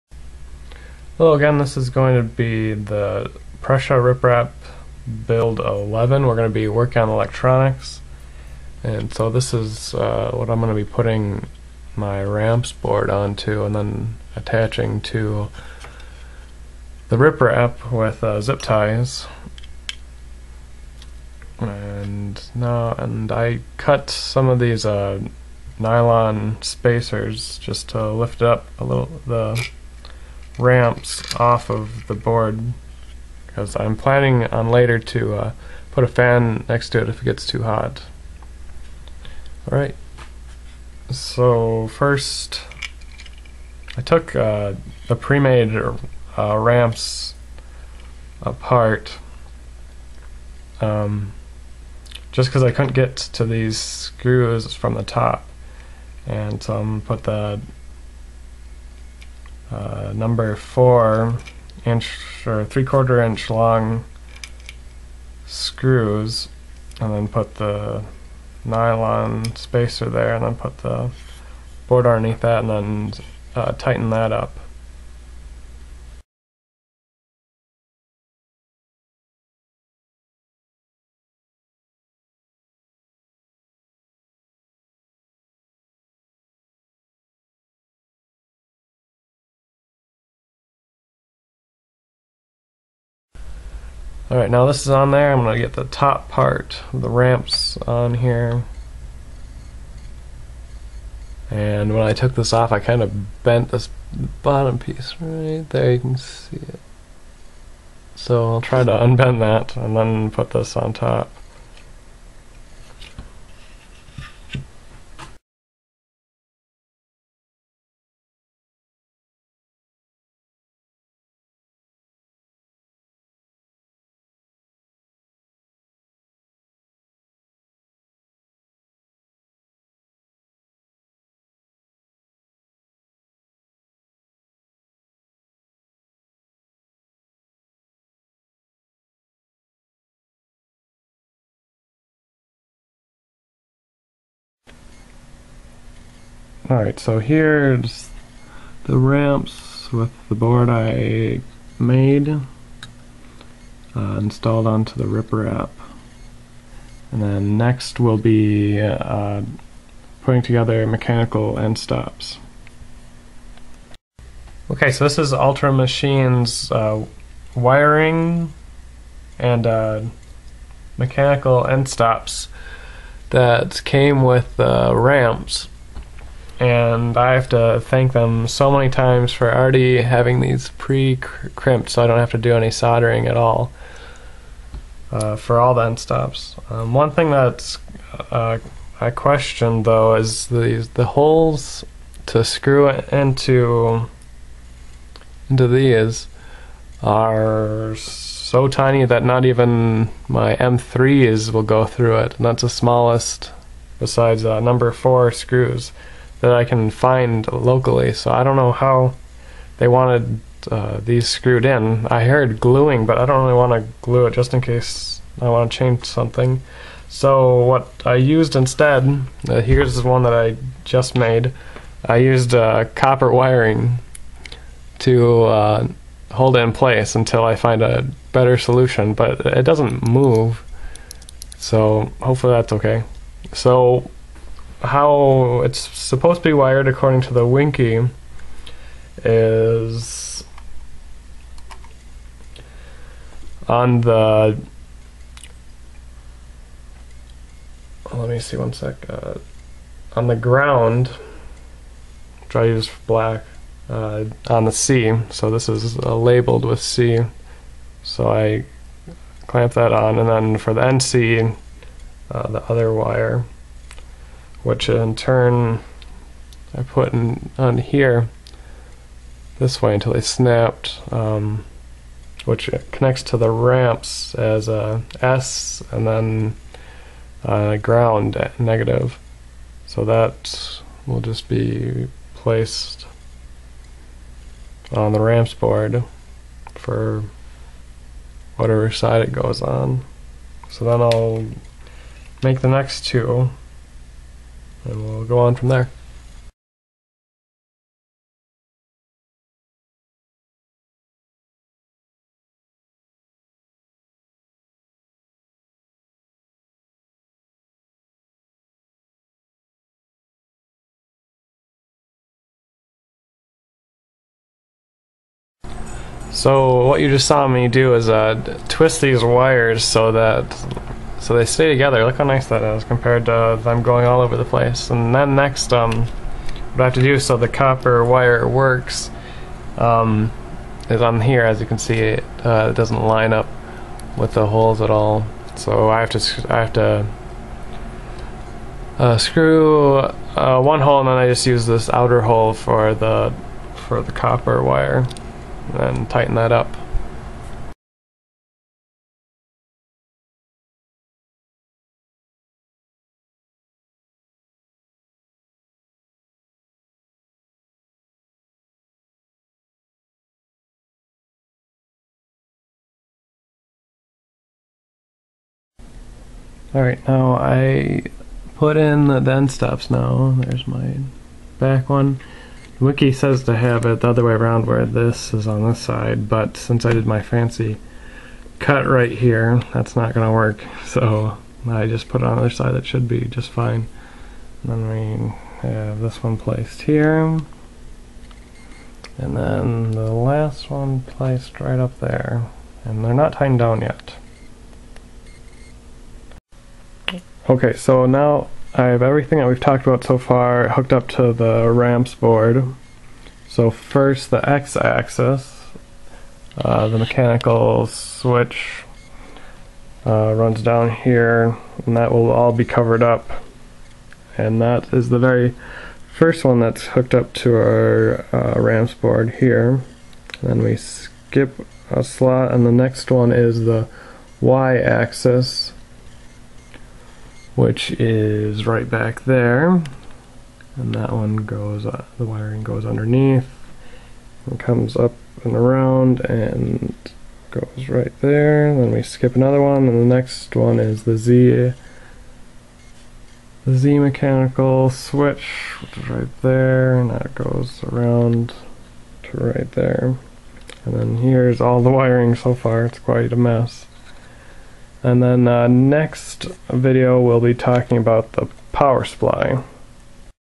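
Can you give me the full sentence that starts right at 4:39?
So that will just be placed on the ramps board for whatever side it goes on.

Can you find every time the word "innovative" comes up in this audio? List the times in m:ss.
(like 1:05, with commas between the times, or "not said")
not said.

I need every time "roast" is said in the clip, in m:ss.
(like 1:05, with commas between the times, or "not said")
not said.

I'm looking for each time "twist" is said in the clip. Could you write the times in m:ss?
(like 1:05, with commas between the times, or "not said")
5:18.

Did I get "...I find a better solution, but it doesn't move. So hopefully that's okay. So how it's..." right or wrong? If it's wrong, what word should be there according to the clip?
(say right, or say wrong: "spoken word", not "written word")
right.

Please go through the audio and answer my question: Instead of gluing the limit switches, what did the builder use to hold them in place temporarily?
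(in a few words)
Copper wiring.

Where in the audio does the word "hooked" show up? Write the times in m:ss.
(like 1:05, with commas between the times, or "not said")
6:40, 6:56.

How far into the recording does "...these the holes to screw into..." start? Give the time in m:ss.
3:10.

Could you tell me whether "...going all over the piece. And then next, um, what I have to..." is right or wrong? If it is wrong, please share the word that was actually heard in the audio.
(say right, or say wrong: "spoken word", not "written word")
wrong: "place", not "piece".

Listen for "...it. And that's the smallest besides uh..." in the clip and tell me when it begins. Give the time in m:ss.
3:22.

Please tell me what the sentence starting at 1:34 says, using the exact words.
Alright, now this is on there.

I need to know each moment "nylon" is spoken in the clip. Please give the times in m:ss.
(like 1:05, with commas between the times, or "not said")
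0:25, 1:08.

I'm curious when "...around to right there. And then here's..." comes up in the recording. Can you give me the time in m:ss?
7:27.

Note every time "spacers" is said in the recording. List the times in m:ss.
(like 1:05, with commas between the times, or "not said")
0:26, 1:09.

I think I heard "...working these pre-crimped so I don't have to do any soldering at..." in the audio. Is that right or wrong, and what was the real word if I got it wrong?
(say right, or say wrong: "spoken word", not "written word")
wrong: "having", not "working".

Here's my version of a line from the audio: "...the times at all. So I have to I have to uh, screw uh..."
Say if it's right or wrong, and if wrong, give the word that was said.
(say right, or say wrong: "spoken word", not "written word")
wrong: "holes", not "times".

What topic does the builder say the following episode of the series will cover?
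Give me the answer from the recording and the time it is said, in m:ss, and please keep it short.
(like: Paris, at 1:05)
The power supply, at 7:38.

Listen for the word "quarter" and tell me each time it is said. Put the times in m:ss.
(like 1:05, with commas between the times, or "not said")
1:02.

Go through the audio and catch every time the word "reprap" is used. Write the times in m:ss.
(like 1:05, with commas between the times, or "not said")
0:04, 0:17, 2:35.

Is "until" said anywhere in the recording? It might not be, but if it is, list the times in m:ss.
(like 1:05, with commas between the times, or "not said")
3:47, 4:29.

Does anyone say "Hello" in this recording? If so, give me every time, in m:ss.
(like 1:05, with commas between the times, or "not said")
0:01.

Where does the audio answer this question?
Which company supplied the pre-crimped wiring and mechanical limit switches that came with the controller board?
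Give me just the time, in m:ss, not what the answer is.
2:45.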